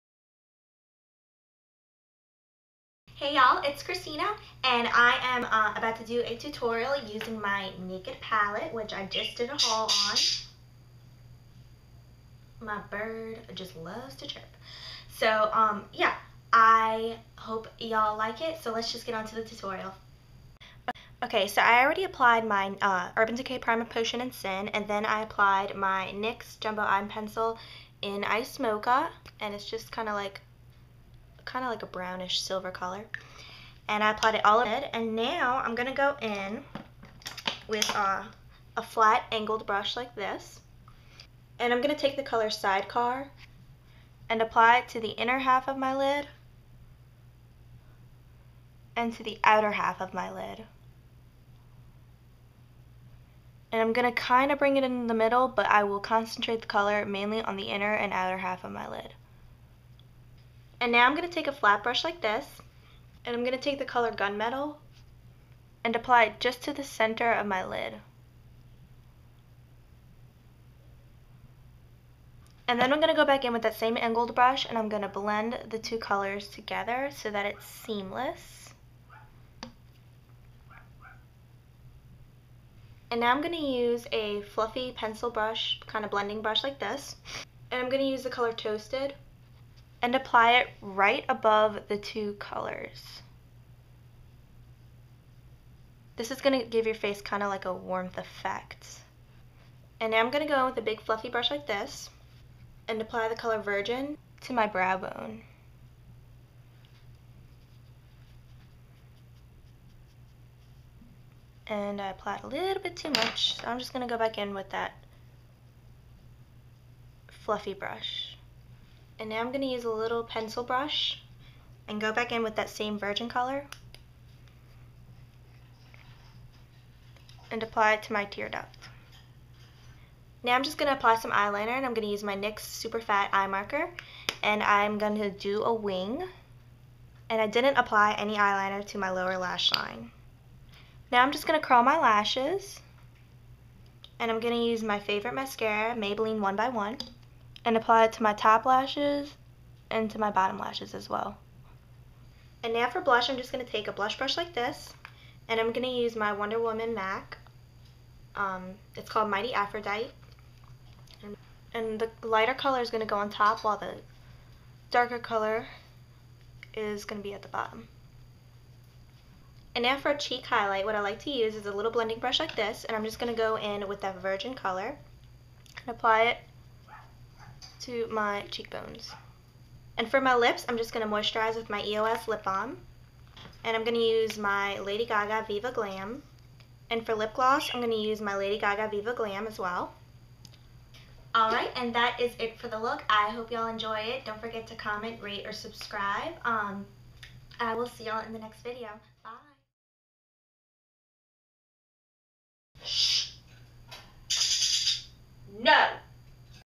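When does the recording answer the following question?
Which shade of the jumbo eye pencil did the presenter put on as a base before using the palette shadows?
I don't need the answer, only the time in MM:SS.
00:28.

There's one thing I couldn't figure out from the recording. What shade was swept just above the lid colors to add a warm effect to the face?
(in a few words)
Toasted.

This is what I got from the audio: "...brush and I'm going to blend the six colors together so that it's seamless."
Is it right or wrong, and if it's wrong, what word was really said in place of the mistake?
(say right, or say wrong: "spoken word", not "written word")
wrong: "two", not "six".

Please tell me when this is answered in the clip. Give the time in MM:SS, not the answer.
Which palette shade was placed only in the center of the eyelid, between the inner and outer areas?
01:04.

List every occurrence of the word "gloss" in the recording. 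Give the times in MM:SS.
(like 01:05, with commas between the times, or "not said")
03:07.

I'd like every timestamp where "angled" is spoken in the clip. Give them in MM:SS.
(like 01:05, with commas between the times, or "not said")
00:39, 01:13.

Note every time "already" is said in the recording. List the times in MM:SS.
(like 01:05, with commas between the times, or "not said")
00:21.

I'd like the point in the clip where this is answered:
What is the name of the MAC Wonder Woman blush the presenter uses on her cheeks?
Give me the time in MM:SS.
02:39.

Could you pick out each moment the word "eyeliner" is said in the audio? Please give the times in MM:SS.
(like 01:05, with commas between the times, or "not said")
02:11, 02:18.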